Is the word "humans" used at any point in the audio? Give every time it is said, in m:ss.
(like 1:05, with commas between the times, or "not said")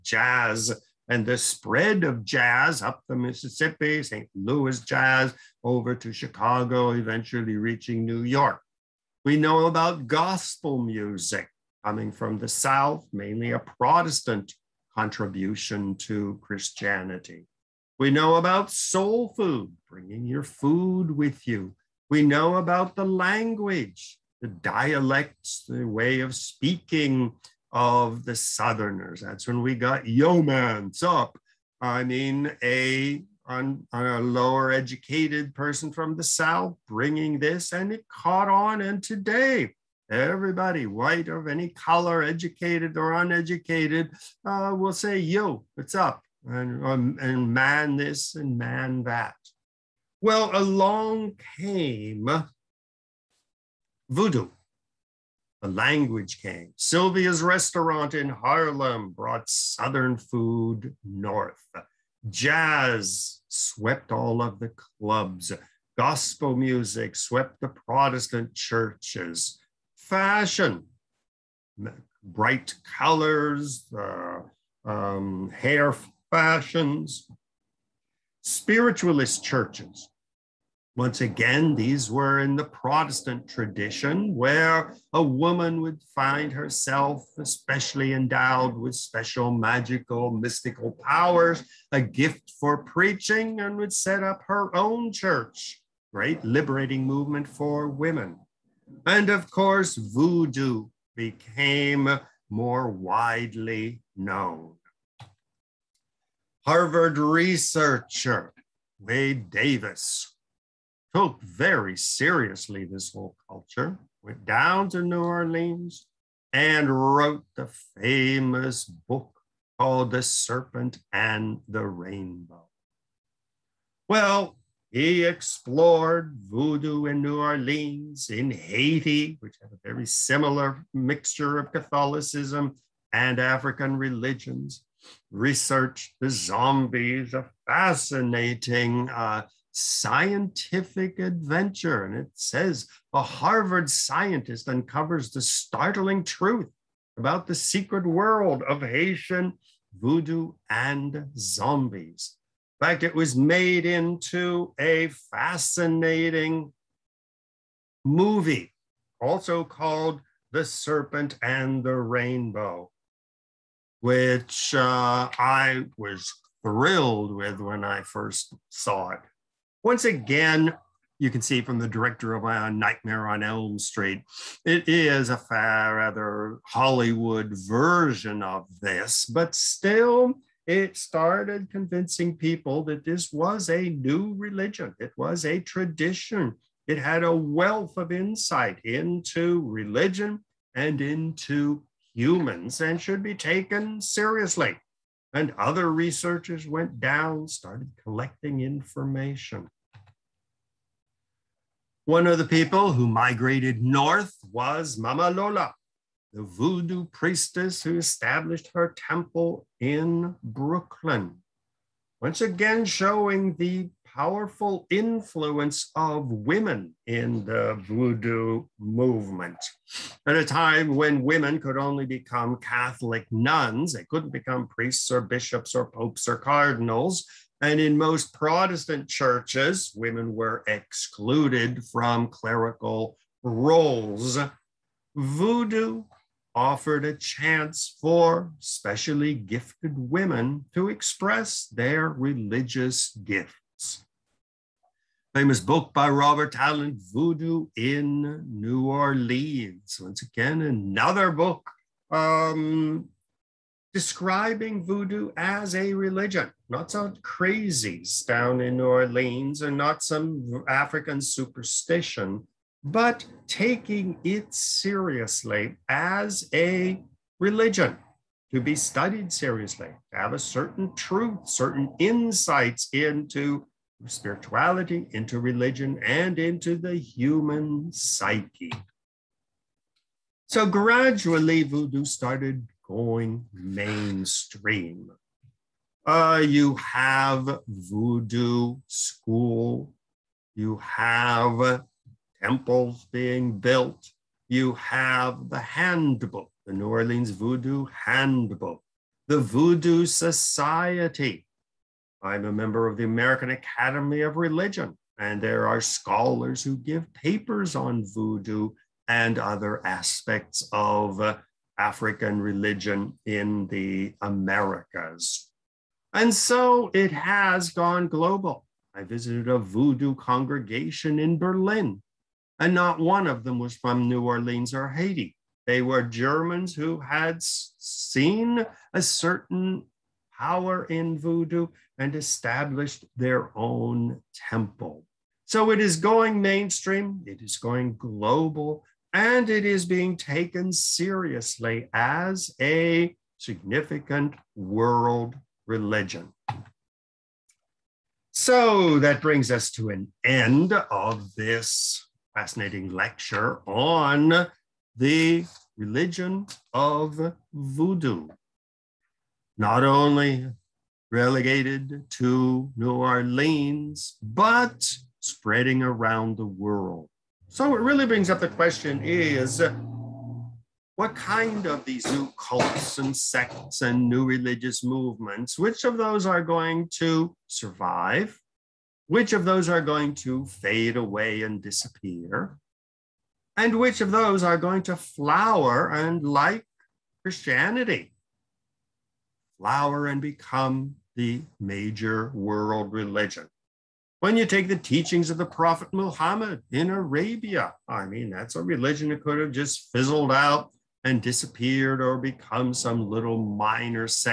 3:12, 4:36.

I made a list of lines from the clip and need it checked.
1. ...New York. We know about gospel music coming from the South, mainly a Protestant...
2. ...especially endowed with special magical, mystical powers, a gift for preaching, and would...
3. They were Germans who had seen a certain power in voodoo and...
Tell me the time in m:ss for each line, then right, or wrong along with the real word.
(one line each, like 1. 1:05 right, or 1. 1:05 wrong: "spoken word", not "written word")
1. 0:08 right
2. 1:27 right
3. 5:25 right.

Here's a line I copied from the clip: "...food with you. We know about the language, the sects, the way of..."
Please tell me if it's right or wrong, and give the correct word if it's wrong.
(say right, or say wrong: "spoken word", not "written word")
wrong: "dialects", not "sects".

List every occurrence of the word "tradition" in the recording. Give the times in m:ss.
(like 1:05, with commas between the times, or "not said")
1:23, 3:05.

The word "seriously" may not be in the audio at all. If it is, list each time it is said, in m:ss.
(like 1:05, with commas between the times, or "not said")
1:51, 3:14, 4:24, 4:29, 5:40.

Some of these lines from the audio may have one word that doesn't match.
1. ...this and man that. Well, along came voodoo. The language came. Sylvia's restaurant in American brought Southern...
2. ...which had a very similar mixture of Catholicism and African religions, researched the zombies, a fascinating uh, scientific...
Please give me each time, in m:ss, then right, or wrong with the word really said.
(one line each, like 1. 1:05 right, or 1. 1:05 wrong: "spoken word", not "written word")
1. 0:47 wrong: "Harlem", not "American"
2. 2:09 right.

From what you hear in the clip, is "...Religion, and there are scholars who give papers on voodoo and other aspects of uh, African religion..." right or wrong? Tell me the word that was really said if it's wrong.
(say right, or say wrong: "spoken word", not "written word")
right.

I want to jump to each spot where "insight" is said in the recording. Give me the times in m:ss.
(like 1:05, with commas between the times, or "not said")
3:08, 4:31.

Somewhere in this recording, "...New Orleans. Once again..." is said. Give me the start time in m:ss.
4:08.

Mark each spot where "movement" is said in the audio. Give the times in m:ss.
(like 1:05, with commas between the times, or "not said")
1:37, 3:38, 6:14.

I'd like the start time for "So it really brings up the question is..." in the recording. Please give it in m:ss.
6:07.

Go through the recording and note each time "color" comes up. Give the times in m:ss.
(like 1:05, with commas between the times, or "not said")
0:41, 1:12.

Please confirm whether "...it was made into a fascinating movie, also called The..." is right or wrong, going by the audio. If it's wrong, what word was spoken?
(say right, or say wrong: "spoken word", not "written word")
right.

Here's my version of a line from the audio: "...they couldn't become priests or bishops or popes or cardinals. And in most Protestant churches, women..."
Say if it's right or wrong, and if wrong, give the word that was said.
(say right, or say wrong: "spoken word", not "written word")
right.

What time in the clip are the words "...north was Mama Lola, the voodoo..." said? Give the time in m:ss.
3:23.